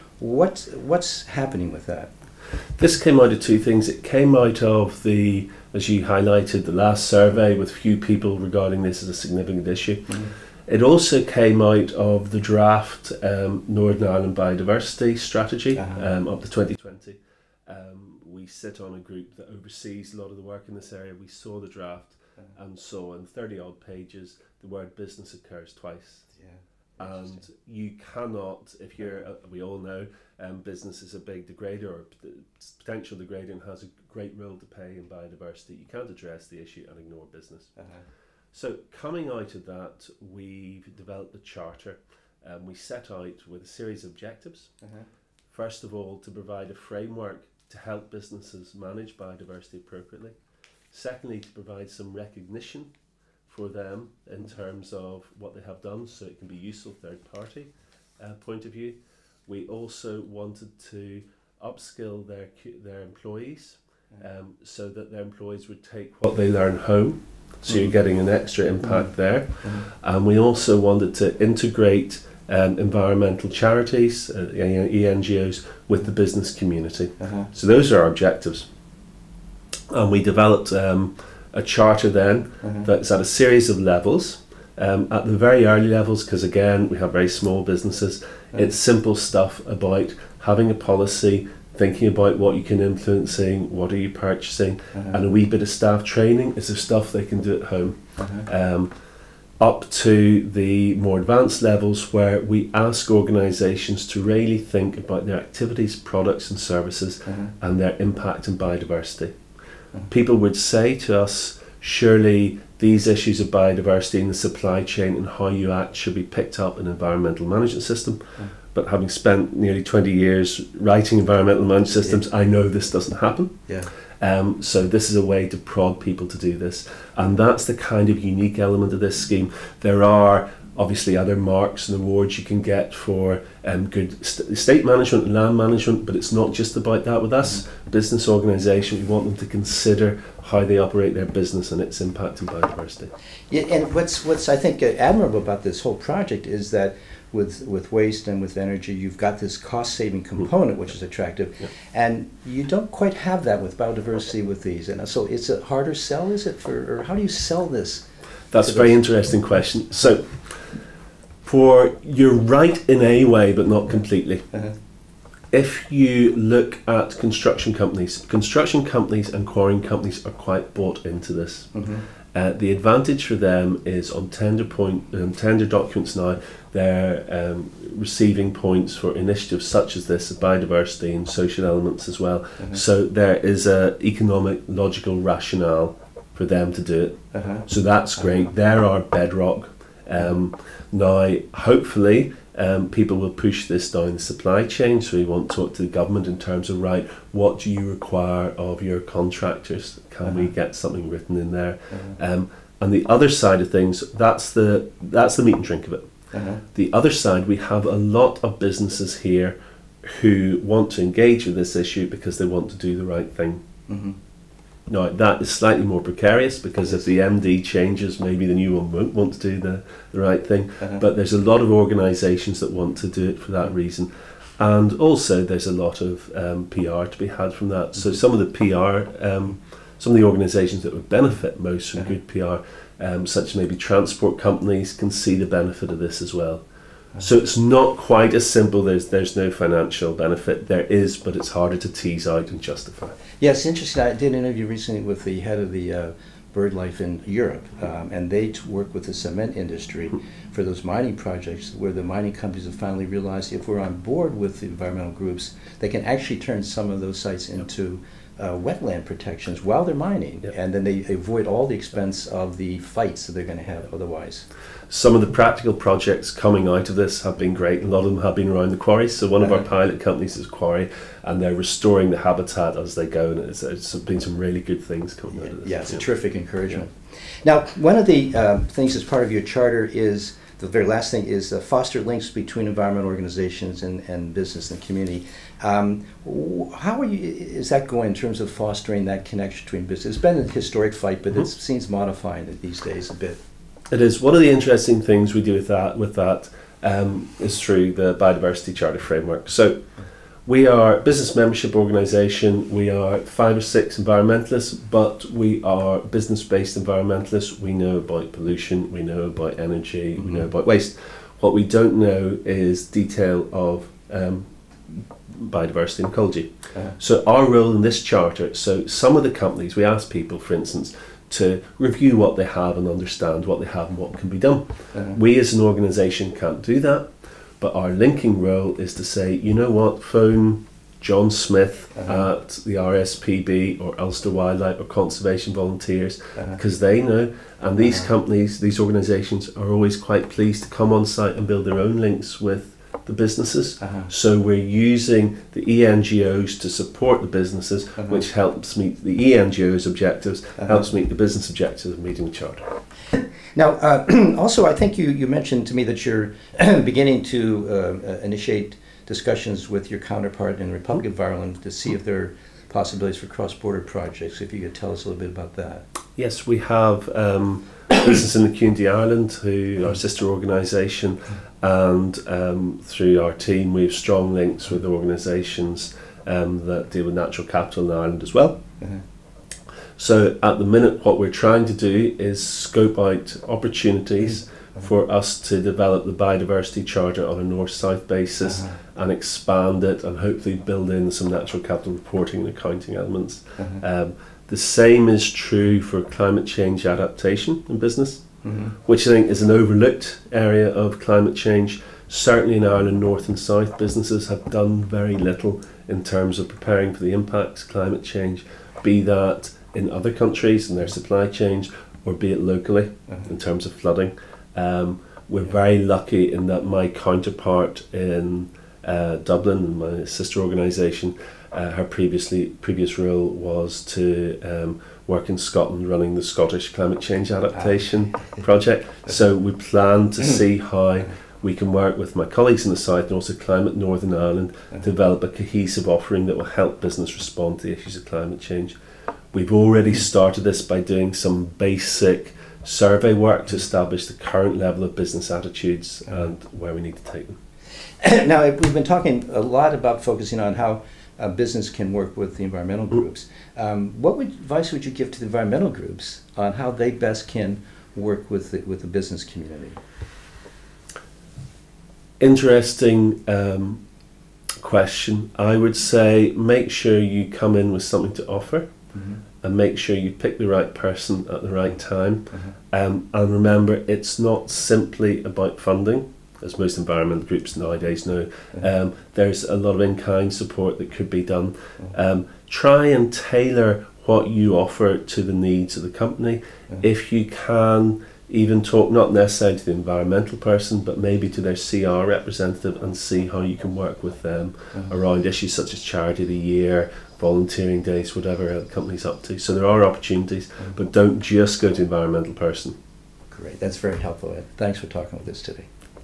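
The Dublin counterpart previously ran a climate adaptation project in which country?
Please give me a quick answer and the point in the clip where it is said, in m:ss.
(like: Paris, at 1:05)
Scotland, at 7:05.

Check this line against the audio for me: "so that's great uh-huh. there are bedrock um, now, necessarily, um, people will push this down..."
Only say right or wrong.
wrong.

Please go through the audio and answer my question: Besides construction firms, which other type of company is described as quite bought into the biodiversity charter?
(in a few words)
quarrying companies.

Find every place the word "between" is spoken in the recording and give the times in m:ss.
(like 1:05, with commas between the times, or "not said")
4:42, 4:49.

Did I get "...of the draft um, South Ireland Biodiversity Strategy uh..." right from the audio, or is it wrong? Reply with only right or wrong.
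wrong.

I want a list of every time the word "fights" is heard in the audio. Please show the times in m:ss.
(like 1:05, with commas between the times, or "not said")
4:22, 4:50.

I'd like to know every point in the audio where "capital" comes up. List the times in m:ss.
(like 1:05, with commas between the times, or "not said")
6:17, 6:31.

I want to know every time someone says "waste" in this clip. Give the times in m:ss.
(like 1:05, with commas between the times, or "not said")
2:27, 5:10.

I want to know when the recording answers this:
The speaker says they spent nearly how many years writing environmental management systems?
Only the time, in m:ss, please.
1:59.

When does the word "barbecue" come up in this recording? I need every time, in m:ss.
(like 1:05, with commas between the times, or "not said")
not said.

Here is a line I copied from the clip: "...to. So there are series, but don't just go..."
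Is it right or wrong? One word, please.
wrong.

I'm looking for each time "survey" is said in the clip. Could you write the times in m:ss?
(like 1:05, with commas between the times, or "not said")
0:07, 7:22.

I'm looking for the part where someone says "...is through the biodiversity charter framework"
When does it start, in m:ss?
4:57.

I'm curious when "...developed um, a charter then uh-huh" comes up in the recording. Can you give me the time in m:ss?
1:20.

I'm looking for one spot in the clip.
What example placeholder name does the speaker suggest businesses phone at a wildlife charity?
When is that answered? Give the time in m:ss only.
5:31.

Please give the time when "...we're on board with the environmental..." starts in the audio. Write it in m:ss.
4:13.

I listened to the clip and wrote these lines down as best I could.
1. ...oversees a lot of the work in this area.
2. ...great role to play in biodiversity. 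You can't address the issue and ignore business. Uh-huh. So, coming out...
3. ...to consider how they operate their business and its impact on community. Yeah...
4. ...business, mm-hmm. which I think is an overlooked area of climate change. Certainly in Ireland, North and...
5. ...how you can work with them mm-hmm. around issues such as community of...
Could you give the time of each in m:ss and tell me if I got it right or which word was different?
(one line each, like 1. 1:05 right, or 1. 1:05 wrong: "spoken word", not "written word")
1. 0:19 right
2. 0:33 right
3. 2:19 wrong: "biodiversity", not "community"
4. 6:37 right
5. 8:13 wrong: "charity", not "community".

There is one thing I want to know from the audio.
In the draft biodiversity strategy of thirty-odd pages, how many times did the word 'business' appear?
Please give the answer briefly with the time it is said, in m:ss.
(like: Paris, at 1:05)
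twice, at 0:25.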